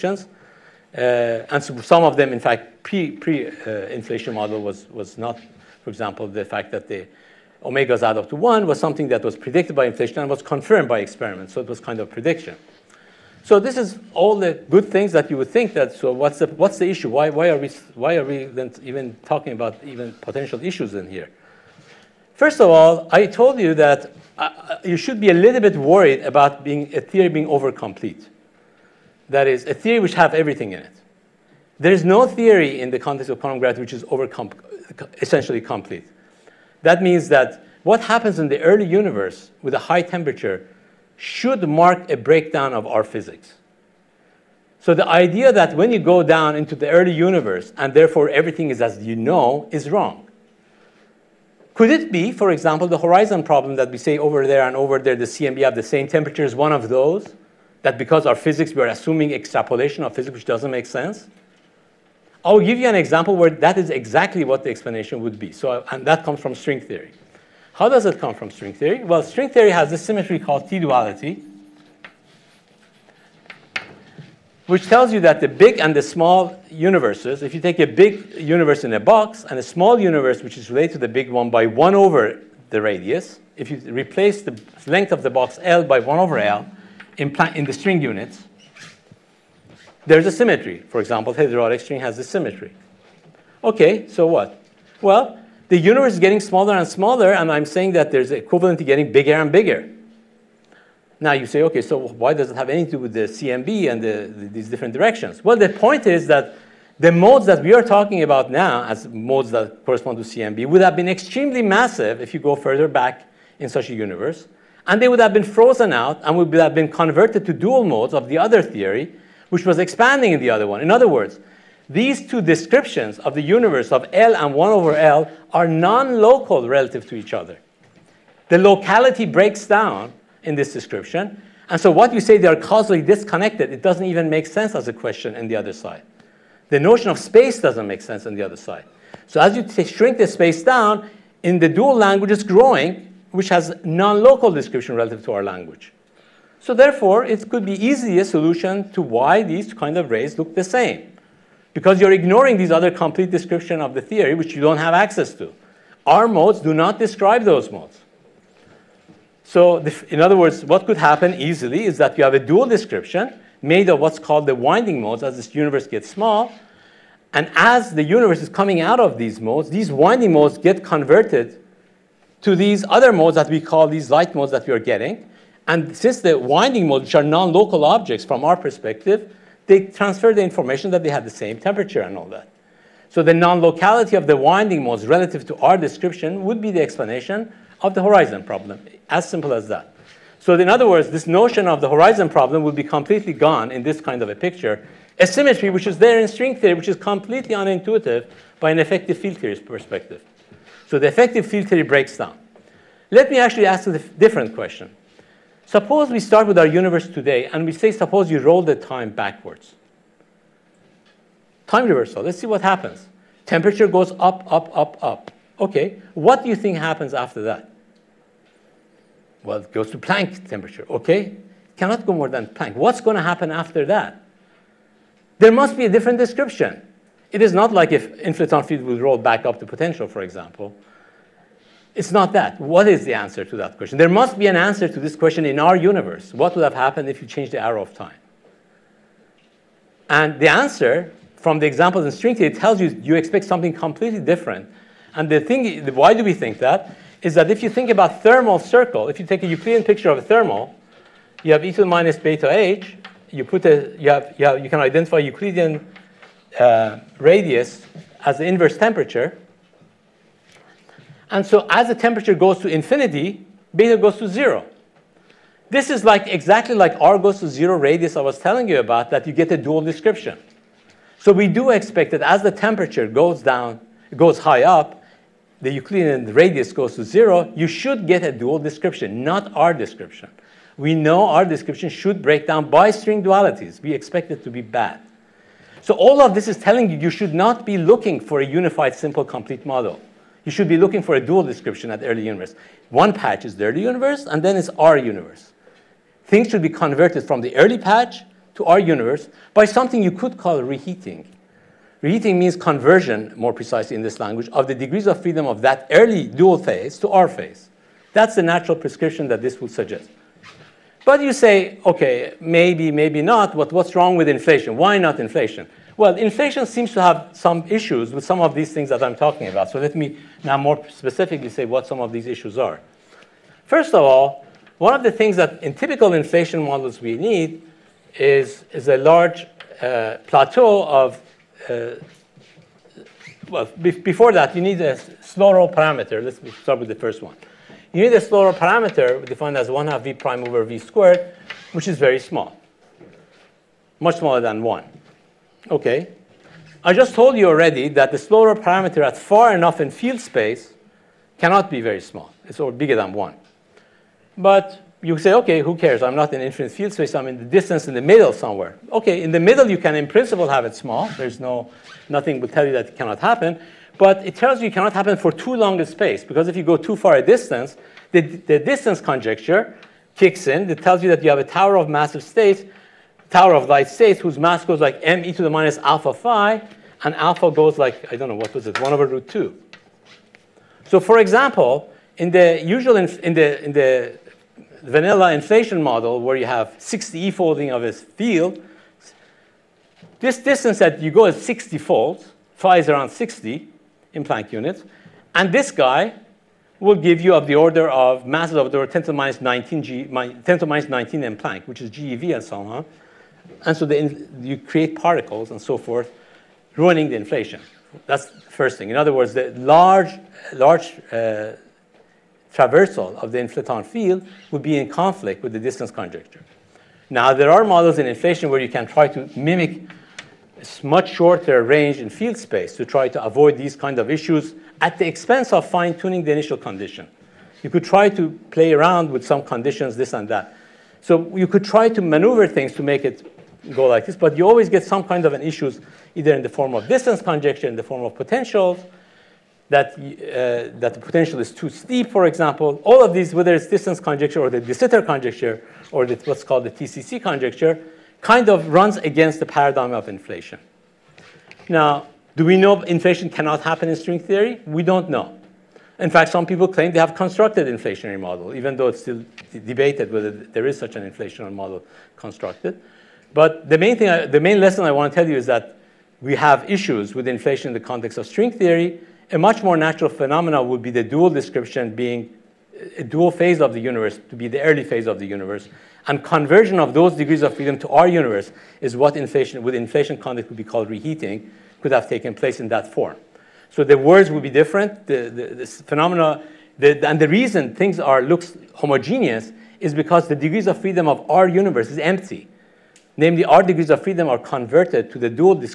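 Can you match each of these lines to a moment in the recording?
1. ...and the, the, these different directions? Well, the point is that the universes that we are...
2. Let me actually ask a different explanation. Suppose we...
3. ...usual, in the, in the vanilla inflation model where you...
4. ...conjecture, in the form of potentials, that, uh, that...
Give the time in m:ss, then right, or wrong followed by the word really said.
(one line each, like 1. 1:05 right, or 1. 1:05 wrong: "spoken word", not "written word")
1. 1:43 wrong: "modes", not "universes"
2. 3:23 wrong: "question", not "explanation"
3. 6:22 right
4. 7:17 right.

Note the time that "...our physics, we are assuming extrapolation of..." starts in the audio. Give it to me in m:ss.
0:58.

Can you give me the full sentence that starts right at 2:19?
So as you shrink the space down, in the dual language it's growing, which has non-local description relative to our language.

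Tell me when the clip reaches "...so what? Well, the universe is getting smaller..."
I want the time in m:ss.
1:34.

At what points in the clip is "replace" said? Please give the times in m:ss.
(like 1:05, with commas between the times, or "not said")
1:23.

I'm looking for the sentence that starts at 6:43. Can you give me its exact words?
And so the, you create particles and so forth, ruining the inflation.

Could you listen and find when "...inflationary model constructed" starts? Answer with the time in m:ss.
7:41.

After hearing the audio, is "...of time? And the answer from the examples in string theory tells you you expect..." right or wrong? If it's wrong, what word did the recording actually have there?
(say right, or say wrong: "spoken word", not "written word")
right.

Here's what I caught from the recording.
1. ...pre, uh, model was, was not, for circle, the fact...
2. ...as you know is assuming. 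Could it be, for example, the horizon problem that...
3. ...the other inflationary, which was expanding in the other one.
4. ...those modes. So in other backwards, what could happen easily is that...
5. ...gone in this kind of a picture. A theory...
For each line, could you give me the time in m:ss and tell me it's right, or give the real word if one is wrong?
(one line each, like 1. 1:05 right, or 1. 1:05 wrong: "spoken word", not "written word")
1. 0:04 wrong: "example", not "circle"
2. 0:48 wrong: "wrong", not "assuming"
3. 1:58 wrong: "theory", not "inflationary"
4. 2:37 wrong: "words", not "backwards"
5. 3:13 wrong: "symmetry", not "theory".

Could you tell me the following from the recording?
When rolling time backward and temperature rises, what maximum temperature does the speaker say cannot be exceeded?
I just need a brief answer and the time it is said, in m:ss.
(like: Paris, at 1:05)
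Planck temperature, at 3:39.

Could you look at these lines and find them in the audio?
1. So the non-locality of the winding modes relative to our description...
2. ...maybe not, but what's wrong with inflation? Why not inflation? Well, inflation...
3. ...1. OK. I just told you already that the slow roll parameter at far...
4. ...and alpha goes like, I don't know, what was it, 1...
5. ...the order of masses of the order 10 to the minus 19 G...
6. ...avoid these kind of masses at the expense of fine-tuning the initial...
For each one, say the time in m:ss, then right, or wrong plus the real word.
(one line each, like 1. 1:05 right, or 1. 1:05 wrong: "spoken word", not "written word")
1. 3:03 right
2. 5:12 right
3. 5:44 right
4. 6:17 right
5. 6:37 right
6. 7:03 wrong: "issues", not "masses".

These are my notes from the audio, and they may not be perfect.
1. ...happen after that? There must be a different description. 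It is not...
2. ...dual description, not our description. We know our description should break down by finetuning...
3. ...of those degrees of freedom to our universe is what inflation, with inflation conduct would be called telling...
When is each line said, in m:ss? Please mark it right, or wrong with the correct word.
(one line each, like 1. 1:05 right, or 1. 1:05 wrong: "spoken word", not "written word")
1. 3:43 right
2. 4:38 wrong: "string", not "finetuning"
3. 7:56 wrong: "reheating", not "telling".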